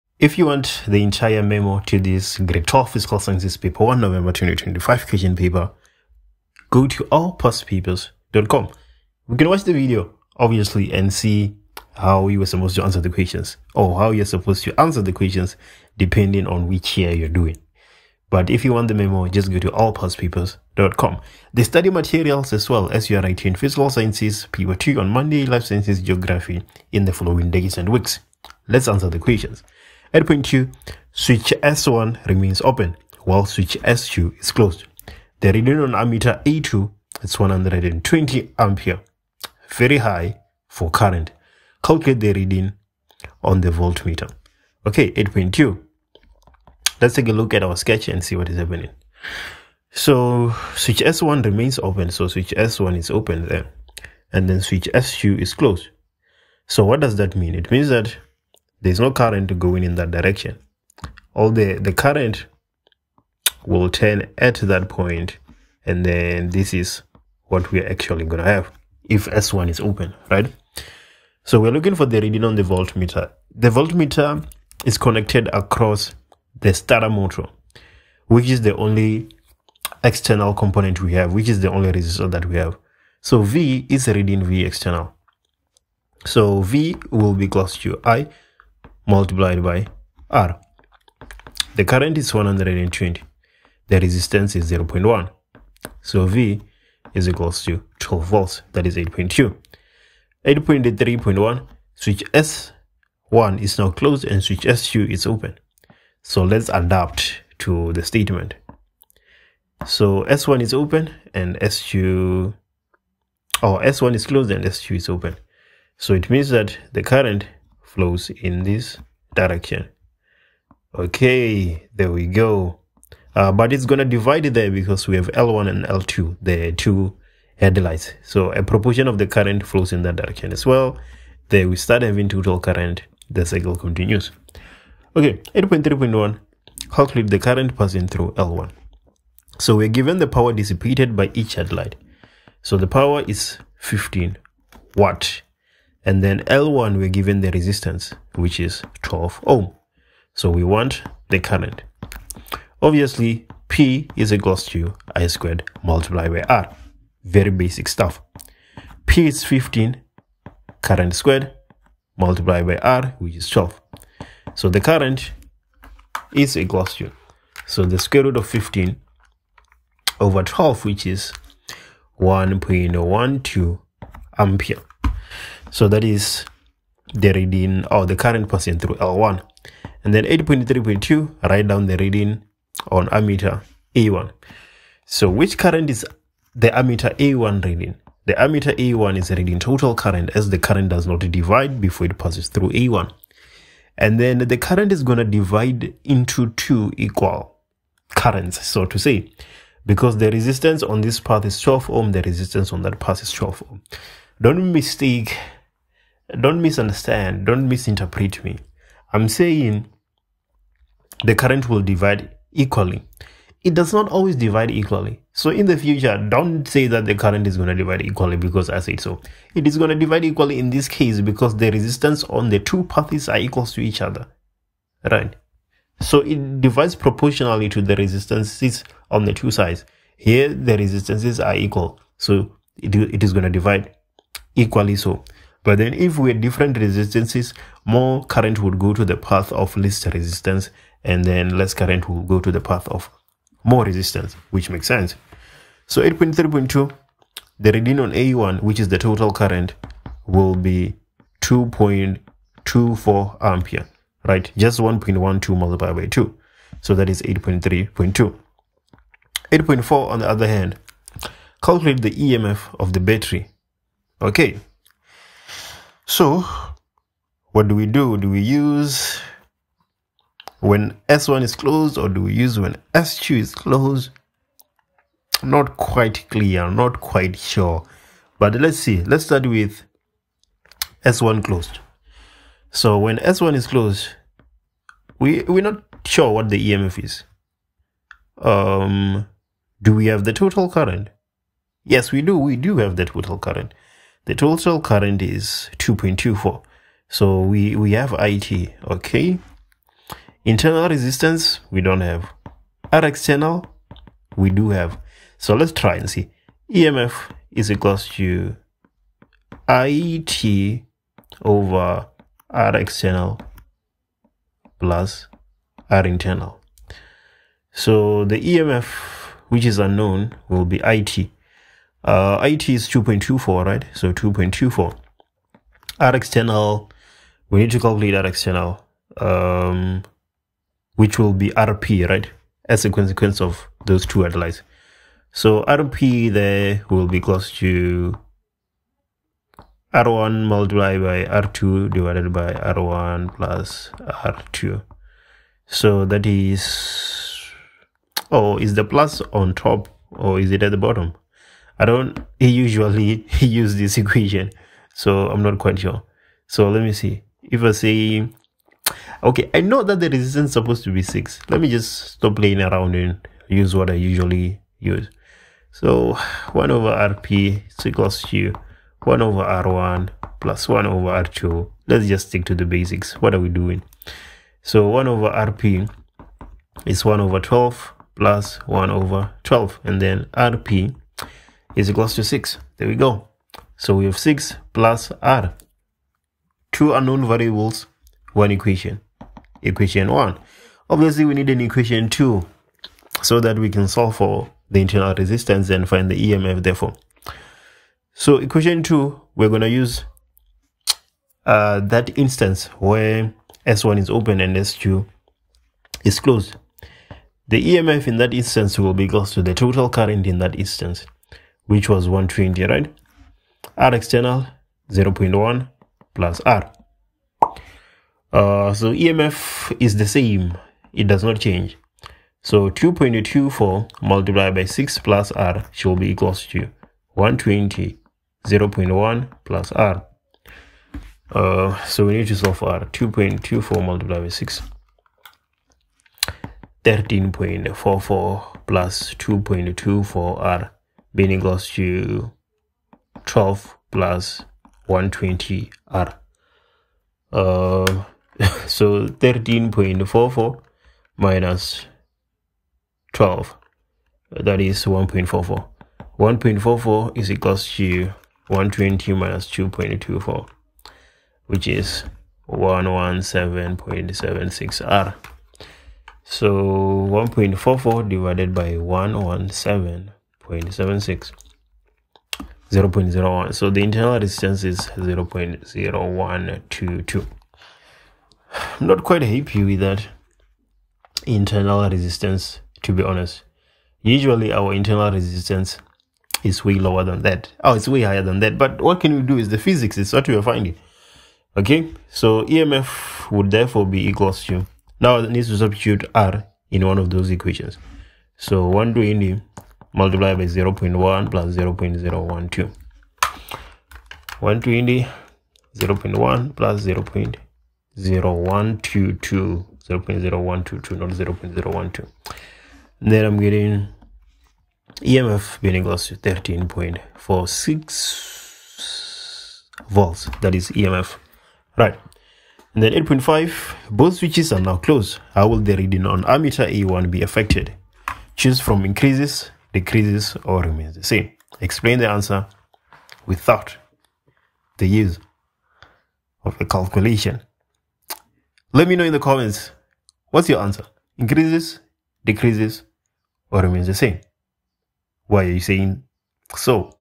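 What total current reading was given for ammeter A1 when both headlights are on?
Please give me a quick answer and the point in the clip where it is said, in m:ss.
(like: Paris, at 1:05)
2.24 ampere, at 4:11.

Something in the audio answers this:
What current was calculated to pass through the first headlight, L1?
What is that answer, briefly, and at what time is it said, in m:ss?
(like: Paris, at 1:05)
1.12 ampere, at 2:52.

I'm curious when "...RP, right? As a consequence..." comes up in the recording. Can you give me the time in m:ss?
5:31.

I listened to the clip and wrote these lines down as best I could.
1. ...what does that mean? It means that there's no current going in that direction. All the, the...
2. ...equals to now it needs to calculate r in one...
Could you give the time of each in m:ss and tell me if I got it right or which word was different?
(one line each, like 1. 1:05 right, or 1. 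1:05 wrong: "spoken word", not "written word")
1. 0:56 right
2. 8:14 wrong: "substitute", not "calculate".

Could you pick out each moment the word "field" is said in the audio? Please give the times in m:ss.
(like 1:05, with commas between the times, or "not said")
not said.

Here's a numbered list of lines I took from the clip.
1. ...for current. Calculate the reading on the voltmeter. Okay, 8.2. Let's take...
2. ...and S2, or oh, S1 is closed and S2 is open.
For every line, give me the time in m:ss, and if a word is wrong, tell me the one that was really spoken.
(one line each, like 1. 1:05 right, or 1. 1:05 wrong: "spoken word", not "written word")
1. 0:40 right
2. 1:51 right.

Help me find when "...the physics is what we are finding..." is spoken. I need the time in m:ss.
8:09.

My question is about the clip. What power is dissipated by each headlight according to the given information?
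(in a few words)
15 watt.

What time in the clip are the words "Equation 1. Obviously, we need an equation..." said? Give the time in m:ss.
6:29.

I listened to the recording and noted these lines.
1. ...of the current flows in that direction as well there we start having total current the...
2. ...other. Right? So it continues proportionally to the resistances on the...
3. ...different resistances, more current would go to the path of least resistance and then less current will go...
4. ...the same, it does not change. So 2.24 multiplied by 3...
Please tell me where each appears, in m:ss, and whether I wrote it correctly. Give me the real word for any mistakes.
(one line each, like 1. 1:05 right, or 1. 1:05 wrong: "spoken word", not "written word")
1. 2:09 right
2. 3:44 wrong: "divides", not "continues"
3. 3:56 right
4. 6:59 wrong: "6", not "3".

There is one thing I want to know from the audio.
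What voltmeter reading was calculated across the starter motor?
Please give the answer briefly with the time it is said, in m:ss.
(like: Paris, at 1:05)
12 volts, at 1:37.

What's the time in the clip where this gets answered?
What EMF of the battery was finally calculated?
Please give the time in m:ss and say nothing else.
8:36.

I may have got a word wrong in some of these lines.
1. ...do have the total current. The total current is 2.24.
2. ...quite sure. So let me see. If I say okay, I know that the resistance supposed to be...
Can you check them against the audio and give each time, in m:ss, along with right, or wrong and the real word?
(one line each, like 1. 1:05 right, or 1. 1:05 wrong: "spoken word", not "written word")
1. 4:52 right
2. 5:55 right.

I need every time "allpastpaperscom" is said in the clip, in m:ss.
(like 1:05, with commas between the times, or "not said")
0:07, 0:19.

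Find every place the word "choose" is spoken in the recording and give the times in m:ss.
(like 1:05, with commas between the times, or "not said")
8:48.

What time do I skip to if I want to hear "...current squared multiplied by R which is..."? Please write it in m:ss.
2:40.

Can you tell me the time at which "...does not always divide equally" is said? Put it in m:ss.
3:33.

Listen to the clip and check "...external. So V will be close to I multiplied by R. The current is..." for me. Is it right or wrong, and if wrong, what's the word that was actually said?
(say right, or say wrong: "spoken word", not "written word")
right.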